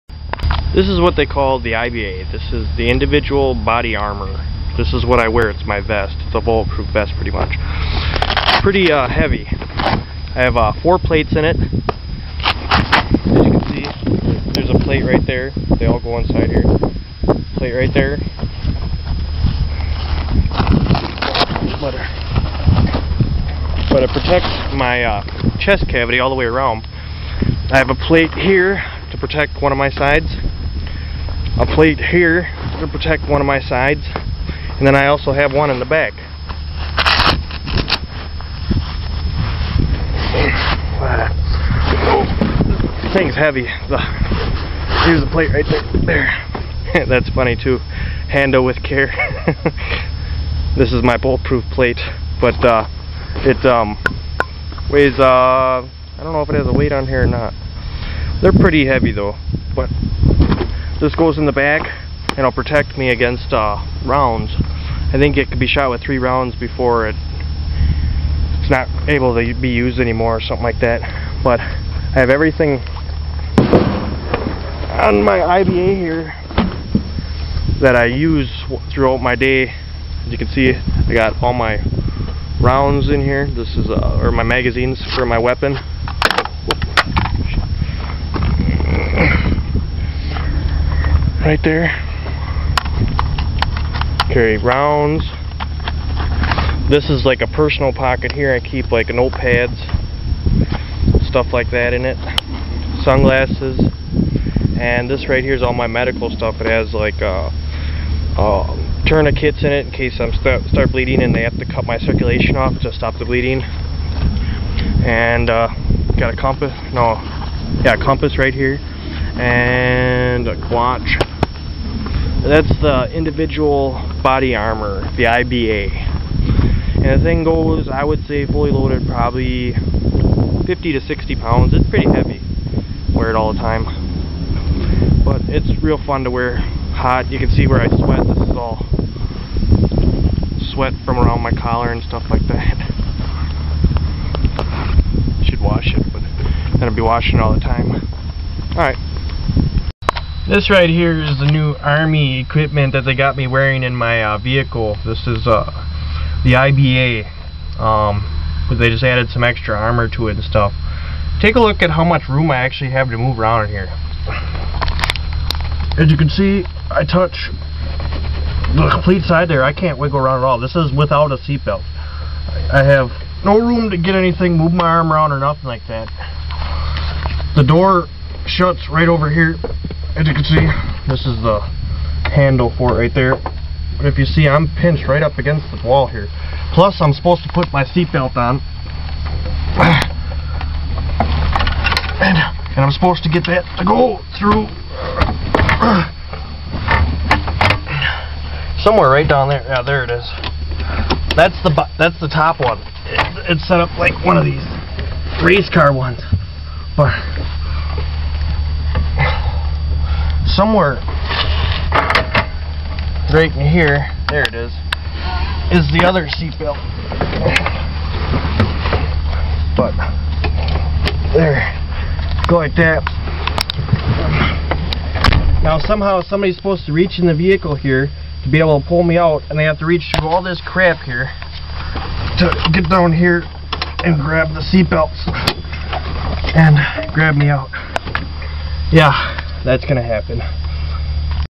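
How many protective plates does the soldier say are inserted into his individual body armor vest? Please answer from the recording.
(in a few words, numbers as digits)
4.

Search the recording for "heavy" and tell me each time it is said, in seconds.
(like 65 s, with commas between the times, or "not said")
9 s, 43 s, 58 s, 132 s.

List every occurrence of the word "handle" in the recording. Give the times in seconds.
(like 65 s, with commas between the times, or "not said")
48 s, 182 s.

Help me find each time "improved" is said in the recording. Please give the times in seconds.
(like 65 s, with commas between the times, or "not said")
not said.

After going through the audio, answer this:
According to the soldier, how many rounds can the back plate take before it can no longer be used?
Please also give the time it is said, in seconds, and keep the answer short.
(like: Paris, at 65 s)
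3, at 66 s.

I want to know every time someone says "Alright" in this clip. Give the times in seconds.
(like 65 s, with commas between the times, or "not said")
148 s.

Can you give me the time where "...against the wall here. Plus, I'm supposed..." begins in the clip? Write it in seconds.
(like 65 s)
185 s.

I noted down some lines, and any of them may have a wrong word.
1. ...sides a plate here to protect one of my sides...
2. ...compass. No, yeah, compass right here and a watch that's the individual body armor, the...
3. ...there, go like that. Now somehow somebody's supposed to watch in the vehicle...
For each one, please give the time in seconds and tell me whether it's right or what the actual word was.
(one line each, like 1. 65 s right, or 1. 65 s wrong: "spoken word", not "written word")
1. 29 s right
2. 116 s right
3. 221 s wrong: "reach", not "watch".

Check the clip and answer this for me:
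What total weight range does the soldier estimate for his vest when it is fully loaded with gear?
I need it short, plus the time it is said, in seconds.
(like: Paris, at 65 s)
50 to 60 pounds, at 130 s.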